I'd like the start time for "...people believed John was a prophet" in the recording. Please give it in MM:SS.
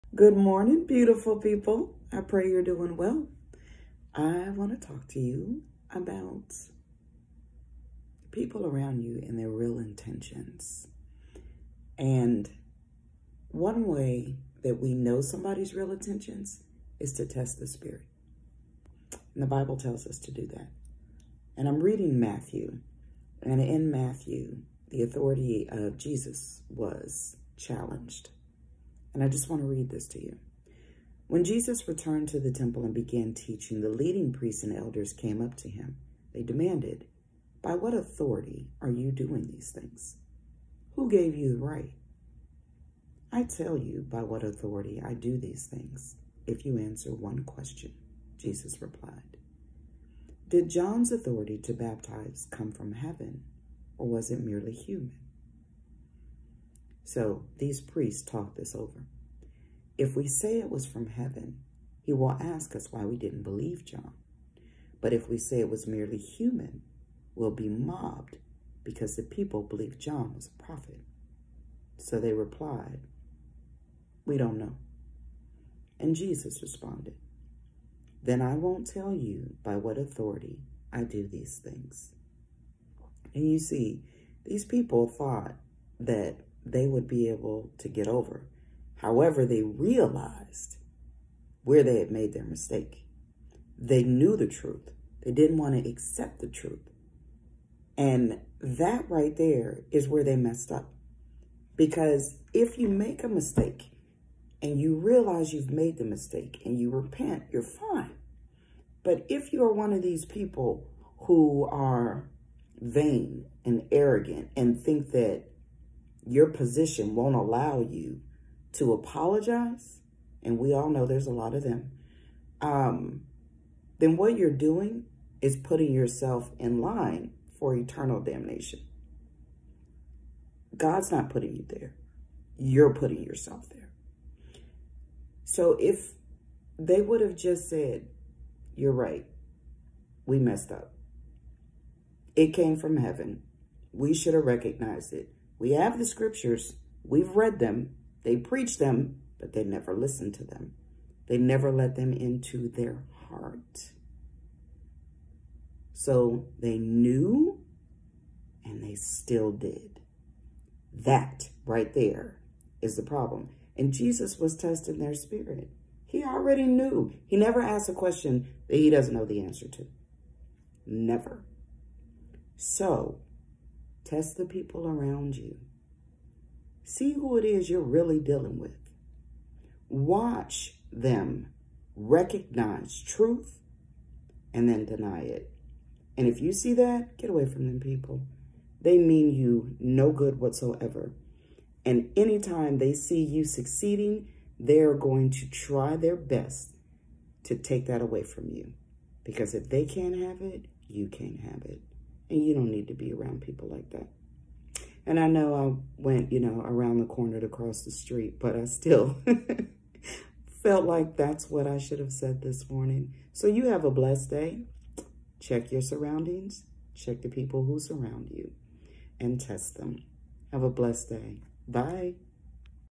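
01:09.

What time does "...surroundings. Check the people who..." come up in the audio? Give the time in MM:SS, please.
03:35.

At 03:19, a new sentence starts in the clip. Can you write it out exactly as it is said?
Because if they can't have it, you can't have it.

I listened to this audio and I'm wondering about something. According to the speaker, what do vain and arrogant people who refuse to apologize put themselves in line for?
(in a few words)
Eternal damnation.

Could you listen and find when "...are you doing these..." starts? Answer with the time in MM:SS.
00:38.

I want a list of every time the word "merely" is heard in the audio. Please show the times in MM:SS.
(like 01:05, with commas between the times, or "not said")
00:54, 01:05.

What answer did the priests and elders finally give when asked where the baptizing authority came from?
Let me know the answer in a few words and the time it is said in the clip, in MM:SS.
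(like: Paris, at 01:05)
We don't know, at 01:14.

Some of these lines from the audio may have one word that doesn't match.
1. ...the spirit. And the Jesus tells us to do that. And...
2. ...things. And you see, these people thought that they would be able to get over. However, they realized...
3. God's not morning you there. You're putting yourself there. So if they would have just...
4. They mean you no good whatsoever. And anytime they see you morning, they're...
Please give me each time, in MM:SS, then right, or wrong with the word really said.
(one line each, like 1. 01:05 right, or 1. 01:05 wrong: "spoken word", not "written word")
1. 00:17 wrong: "Bible", not "Jesus"
2. 01:21 right
3. 02:10 wrong: "putting", not "morning"
4. 03:08 wrong: "succeeding", not "morning".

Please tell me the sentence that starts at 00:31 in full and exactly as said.
When Jesus returned to the temple and began teaching, the leading priests and elders came up to him.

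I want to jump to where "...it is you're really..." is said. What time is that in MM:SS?
02:57.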